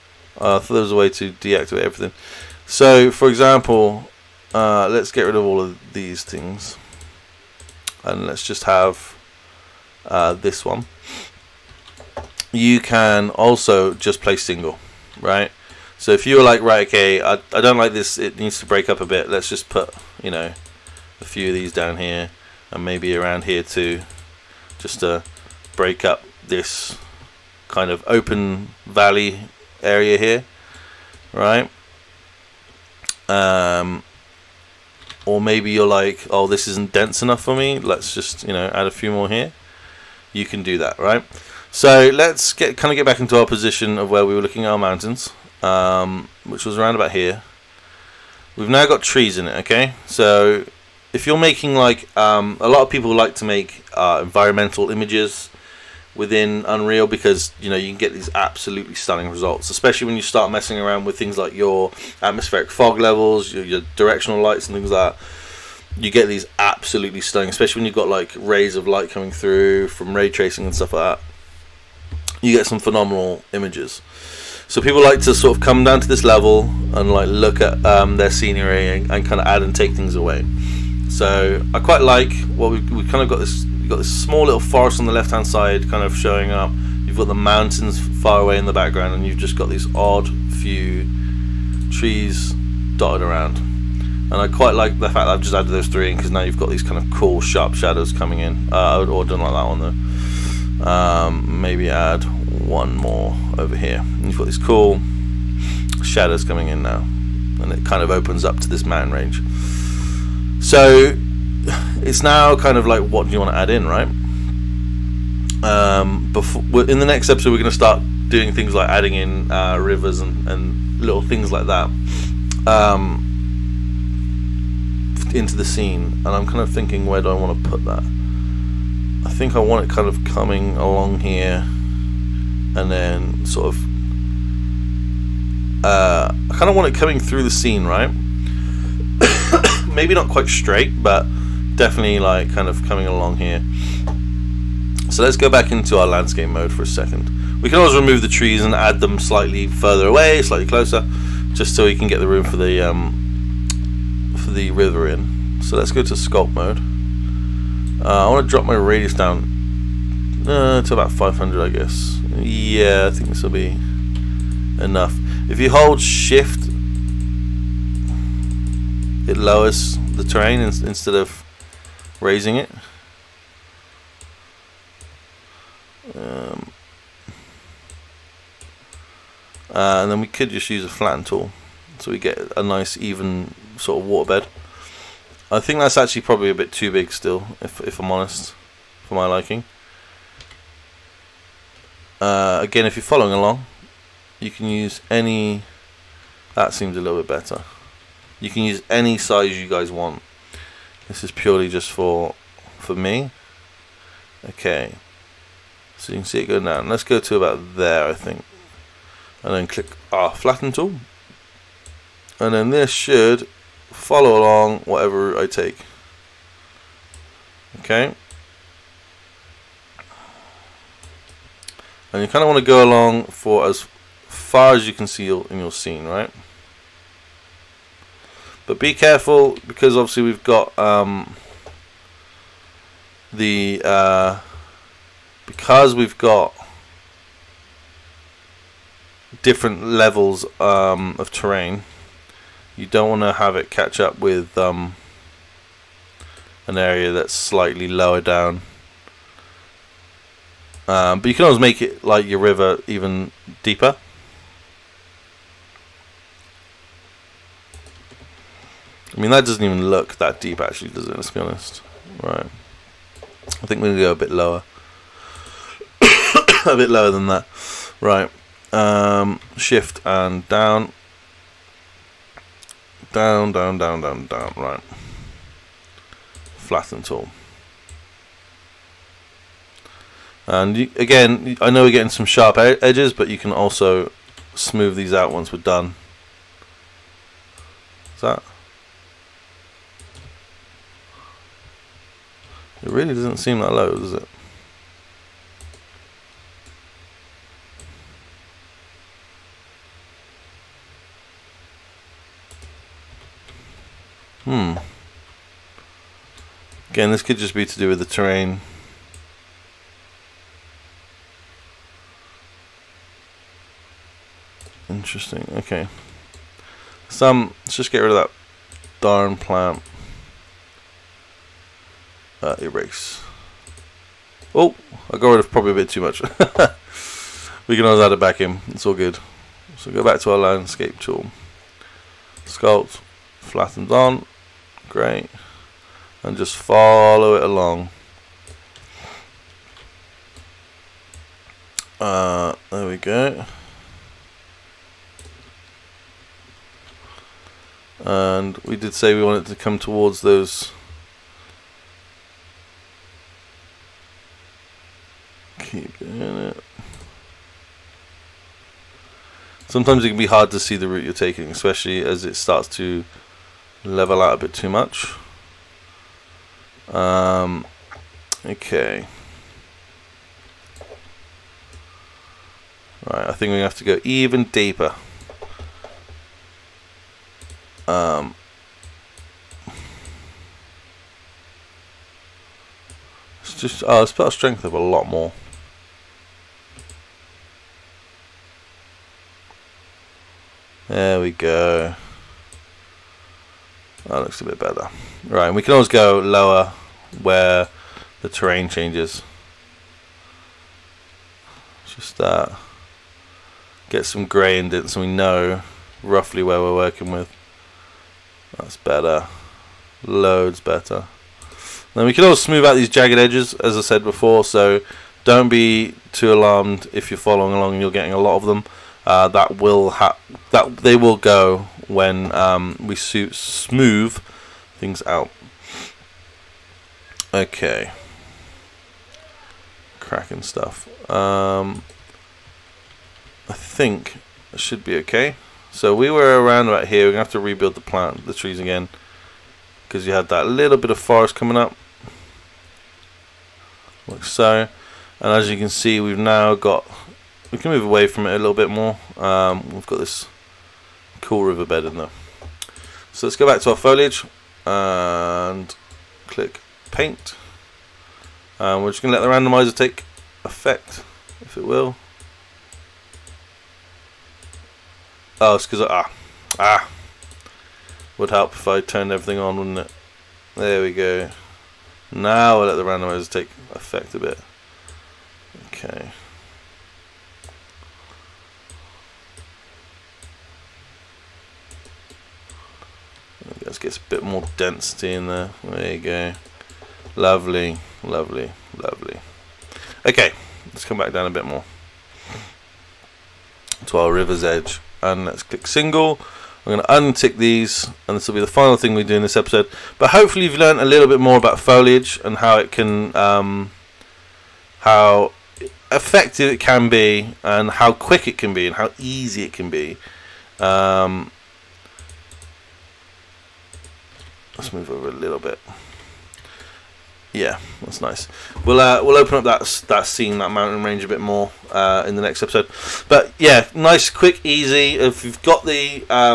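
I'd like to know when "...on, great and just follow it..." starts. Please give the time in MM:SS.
05:33.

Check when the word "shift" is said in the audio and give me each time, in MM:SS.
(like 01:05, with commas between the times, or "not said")
02:46, 04:29.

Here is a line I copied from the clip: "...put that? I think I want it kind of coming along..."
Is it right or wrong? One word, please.
right.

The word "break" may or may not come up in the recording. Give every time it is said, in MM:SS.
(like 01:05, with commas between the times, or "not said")
00:18, 00:25.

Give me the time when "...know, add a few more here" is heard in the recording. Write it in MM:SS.
00:38.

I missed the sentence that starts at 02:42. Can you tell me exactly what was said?
Yeah, I think this will be enough.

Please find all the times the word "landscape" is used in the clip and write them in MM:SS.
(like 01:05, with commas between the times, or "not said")
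02:26, 05:30.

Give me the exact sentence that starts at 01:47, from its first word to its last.
And it kind of opens up to this mountain range.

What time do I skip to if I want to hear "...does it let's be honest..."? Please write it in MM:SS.
04:20.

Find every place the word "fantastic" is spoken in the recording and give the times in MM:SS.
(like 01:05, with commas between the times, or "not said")
not said.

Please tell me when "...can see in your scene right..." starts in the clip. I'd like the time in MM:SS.
03:44.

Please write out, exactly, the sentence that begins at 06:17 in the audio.
Um, it's just, oh, let's put our strength up a lot more.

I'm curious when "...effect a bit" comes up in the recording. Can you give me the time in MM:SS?
07:53.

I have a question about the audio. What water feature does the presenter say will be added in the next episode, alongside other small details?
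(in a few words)
Rivers.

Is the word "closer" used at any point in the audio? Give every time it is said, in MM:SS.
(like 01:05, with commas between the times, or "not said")
02:30.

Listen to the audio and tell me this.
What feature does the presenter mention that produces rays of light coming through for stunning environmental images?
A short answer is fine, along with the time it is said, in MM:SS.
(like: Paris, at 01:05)
Ray tracing, at 01:10.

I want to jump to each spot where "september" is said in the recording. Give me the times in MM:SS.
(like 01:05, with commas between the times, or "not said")
not said.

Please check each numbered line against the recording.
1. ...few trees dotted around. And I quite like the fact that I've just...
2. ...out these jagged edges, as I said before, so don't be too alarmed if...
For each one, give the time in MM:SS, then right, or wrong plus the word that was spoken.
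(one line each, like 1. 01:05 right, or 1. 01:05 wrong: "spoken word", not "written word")
1. 01:30 right
2. 06:52 right.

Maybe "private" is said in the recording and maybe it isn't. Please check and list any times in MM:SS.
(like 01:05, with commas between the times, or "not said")
not said.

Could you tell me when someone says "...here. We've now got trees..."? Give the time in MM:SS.
00:47.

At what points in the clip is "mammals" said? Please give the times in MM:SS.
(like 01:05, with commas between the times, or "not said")
not said.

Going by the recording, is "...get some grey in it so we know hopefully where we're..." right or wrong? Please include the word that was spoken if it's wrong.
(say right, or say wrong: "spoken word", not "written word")
wrong: "roughly", not "hopefully".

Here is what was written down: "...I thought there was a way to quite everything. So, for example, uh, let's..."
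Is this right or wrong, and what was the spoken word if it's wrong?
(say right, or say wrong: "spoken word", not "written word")
wrong: "deactivate", not "quite".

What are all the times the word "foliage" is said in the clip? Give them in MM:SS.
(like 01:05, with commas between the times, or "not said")
07:33, 08:21.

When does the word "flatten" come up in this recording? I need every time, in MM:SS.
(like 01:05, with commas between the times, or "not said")
03:00, 03:30, 04:36, 05:33.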